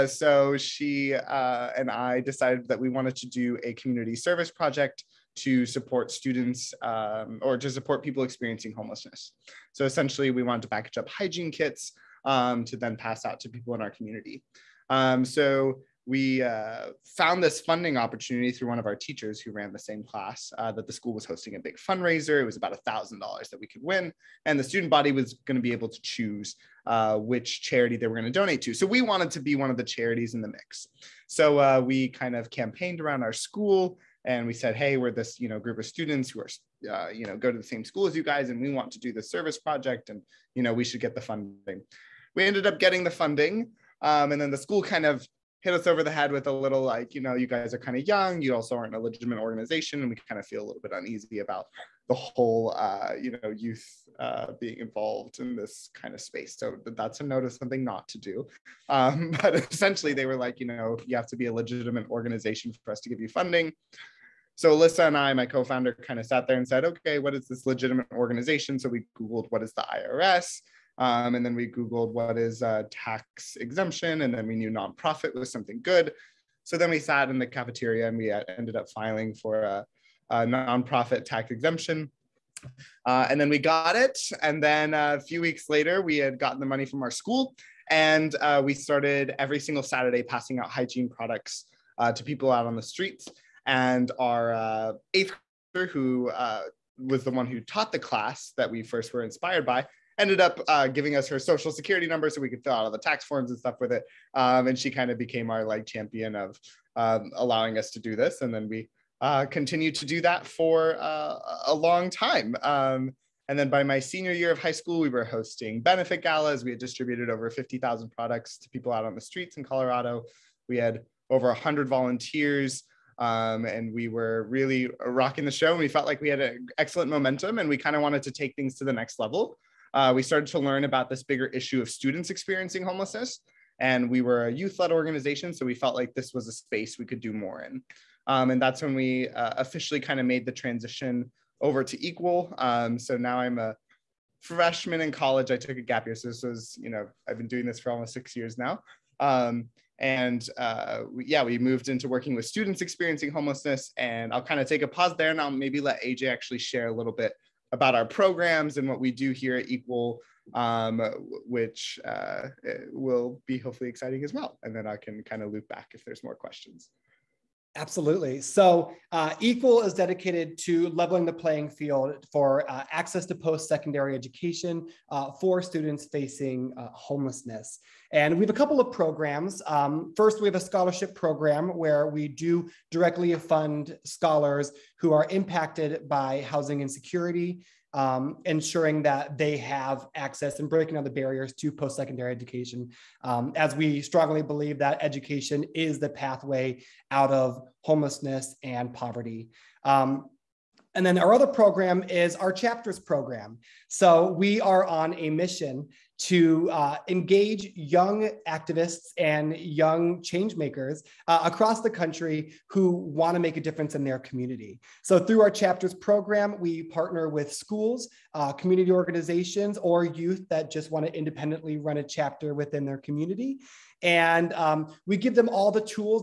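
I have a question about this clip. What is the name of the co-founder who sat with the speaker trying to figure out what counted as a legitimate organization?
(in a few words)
Alyssa.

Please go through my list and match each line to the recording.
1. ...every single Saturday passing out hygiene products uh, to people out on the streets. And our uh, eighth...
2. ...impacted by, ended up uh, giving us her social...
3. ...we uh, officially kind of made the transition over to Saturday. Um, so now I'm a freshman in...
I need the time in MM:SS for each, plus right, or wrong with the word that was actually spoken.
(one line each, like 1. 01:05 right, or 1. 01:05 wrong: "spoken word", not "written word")
1. 01:29 right
2. 01:39 wrong: "inspired", not "impacted"
3. 02:18 wrong: "Equal", not "Saturday".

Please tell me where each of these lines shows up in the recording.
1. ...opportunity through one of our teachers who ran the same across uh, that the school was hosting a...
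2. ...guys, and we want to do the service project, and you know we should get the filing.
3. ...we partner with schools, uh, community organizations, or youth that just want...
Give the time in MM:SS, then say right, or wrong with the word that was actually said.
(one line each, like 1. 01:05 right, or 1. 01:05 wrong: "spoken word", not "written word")
1. 00:17 wrong: "class", not "across"
2. 00:38 wrong: "funding", not "filing"
3. 03:36 right.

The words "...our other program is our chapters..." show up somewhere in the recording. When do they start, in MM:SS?
03:21.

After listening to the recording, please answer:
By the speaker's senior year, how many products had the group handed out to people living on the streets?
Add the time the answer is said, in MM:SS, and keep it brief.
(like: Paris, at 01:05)
50,000, at 01:57.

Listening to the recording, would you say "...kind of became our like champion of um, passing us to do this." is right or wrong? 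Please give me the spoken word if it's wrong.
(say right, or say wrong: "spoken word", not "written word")
wrong: "allowing", not "passing".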